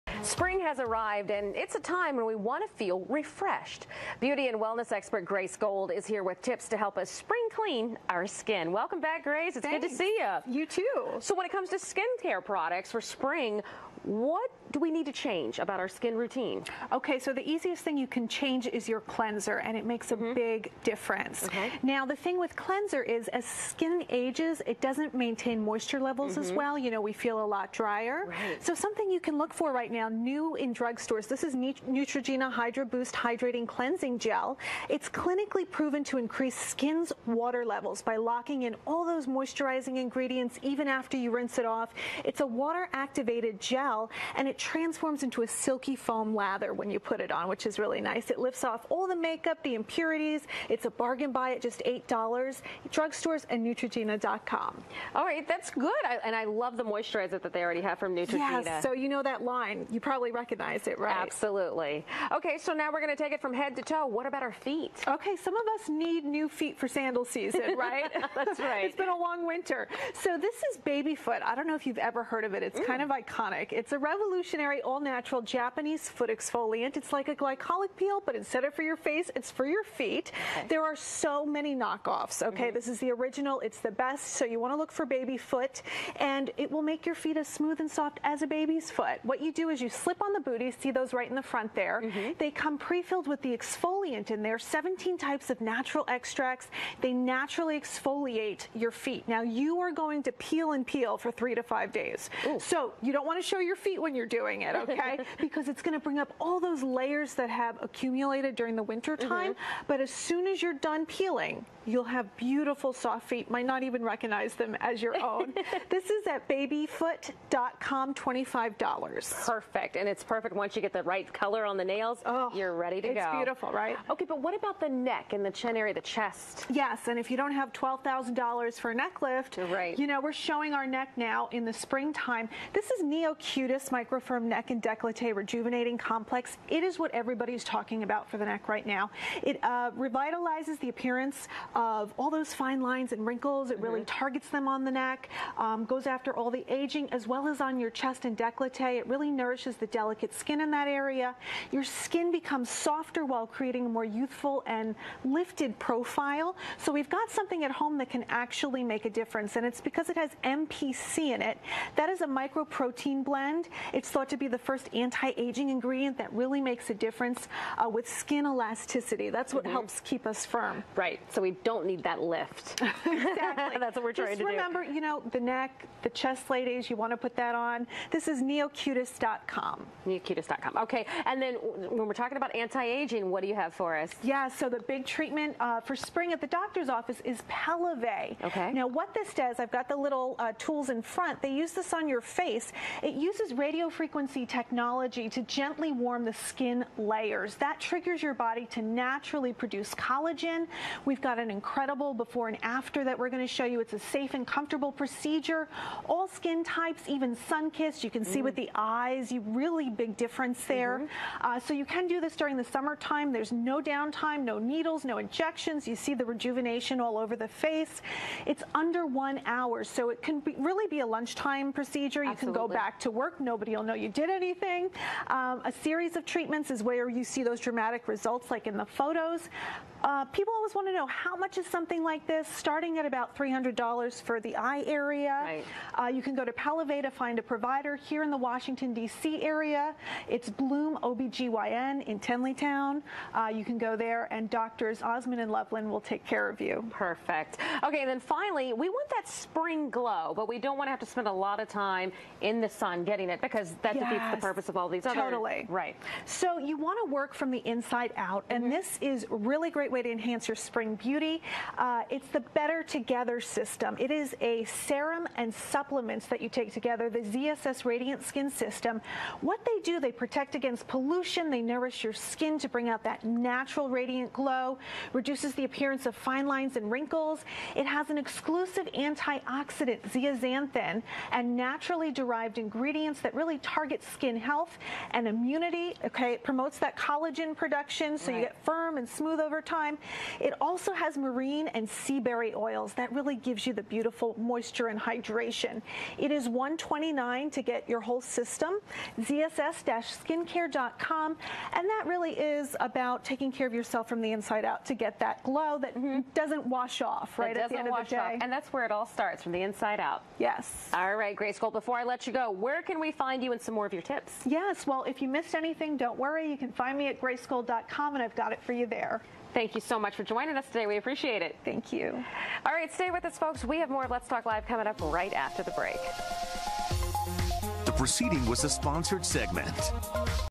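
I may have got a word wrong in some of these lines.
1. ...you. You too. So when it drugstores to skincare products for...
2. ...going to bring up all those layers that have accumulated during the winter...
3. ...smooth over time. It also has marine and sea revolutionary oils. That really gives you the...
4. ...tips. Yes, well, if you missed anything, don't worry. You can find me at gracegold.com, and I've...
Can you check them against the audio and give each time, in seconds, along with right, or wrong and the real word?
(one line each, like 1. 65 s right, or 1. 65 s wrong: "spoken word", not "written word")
1. 10 s wrong: "comes", not "drugstores"
2. 105 s right
3. 289 s wrong: "berry", not "revolutionary"
4. 314 s right.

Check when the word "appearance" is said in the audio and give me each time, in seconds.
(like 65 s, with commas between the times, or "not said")
140 s, 275 s.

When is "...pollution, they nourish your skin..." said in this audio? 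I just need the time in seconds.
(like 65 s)
270 s.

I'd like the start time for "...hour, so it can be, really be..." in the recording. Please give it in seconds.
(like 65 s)
219 s.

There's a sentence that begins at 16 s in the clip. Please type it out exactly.
Okay, so the easiest thing you can change is your cleanser, and it makes a mm -hmm.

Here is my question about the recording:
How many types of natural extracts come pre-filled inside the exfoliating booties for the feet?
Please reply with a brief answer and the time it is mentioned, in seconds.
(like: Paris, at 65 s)
17, at 94 s.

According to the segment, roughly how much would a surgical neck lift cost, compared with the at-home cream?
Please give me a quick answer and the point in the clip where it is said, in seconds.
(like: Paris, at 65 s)
$12,000, at 127 s.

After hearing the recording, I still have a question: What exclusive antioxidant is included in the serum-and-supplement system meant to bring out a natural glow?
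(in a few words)
zeaxanthin.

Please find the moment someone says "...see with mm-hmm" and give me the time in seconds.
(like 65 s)
208 s.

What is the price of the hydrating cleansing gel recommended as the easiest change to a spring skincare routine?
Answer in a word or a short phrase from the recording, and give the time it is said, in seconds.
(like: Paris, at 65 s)
$8, at 51 s.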